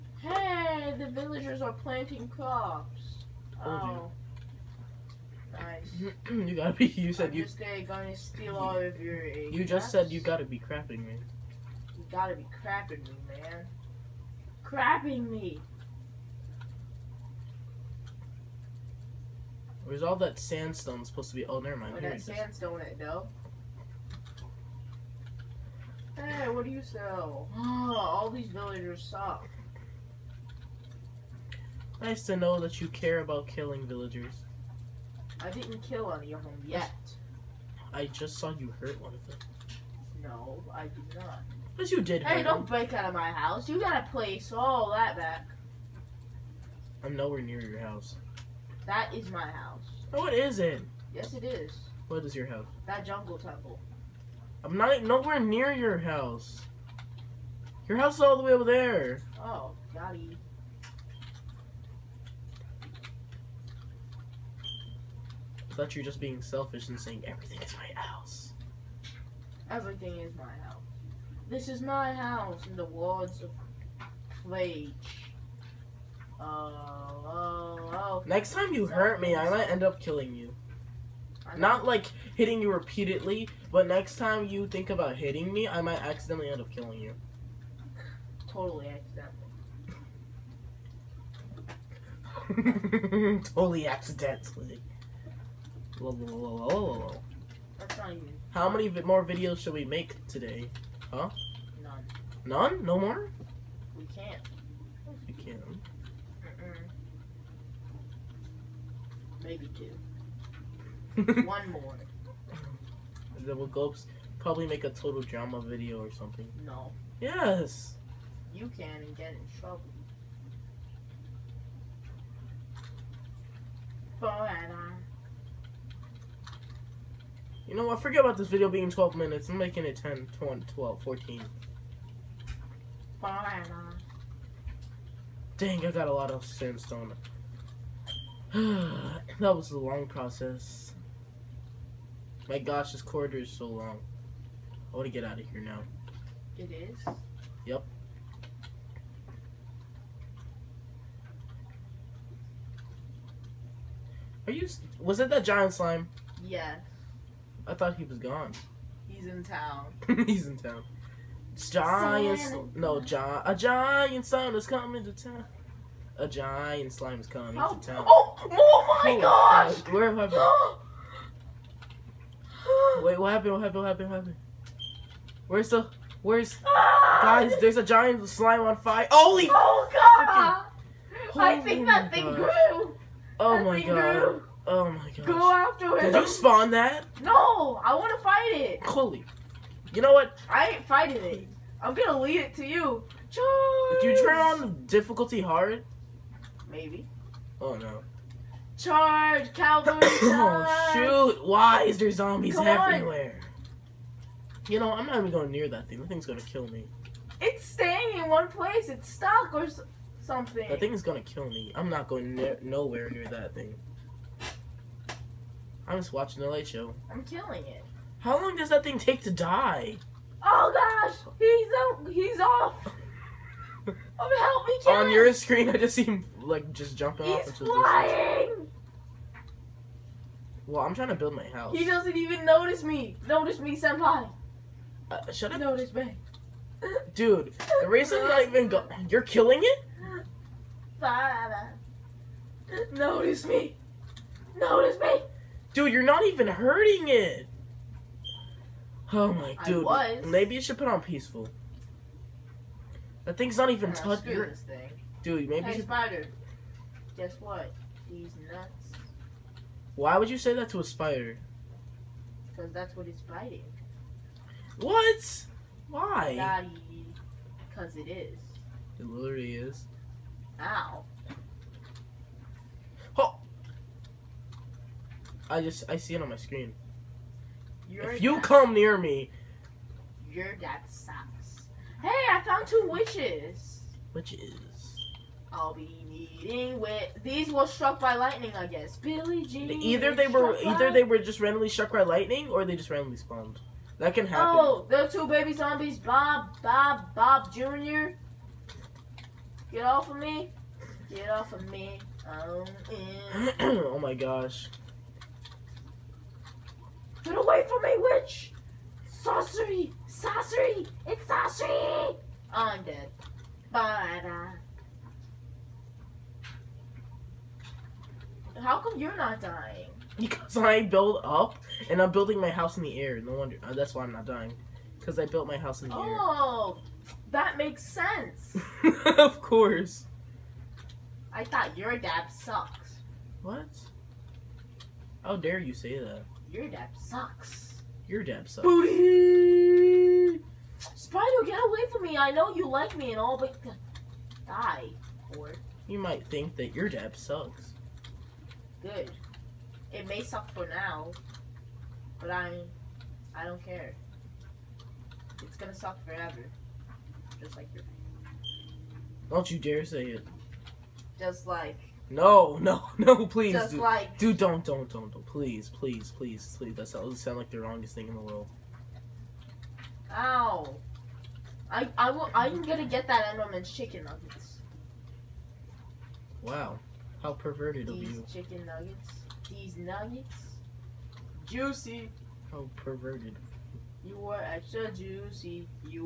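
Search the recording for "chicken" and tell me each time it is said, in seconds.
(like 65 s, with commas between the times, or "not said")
373 s, 378 s.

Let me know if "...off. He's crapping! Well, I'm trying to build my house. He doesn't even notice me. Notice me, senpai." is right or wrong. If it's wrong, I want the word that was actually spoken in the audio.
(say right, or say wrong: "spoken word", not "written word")
wrong: "flying", not "crapping".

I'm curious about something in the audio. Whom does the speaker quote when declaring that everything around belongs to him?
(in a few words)
Plague.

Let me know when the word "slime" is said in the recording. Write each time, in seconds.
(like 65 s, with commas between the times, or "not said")
155 s, 166 s, 178 s.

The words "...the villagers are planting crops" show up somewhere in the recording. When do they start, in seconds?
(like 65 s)
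0 s.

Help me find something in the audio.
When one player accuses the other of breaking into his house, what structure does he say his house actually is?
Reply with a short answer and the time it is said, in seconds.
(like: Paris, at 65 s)
jungle temple, at 52 s.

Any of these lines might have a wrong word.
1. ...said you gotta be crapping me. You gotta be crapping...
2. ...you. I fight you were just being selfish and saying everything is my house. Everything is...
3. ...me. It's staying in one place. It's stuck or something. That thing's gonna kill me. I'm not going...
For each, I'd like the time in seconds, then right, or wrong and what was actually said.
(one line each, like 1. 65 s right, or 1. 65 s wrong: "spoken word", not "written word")
1. 9 s right
2. 60 s wrong: "thought", not "fight"
3. 206 s right.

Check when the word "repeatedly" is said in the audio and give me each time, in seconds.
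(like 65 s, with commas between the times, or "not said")
82 s.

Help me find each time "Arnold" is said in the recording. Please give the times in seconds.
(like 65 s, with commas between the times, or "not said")
not said.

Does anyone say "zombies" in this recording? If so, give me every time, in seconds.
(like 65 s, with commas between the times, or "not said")
202 s, 295 s.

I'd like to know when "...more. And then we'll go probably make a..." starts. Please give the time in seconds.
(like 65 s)
111 s.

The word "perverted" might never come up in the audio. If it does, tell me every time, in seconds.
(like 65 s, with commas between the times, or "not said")
377 s, 382 s.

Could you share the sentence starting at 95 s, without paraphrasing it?
Whoa, whoa, whoa, That's not even.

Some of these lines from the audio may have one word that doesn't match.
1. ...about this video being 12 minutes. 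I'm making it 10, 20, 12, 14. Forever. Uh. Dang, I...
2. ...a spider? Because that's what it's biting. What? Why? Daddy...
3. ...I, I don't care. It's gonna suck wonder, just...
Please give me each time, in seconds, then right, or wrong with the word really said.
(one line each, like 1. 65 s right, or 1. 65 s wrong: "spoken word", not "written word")
1. 128 s right
2. 260 s right
3. 352 s wrong: "forever", not "wonder".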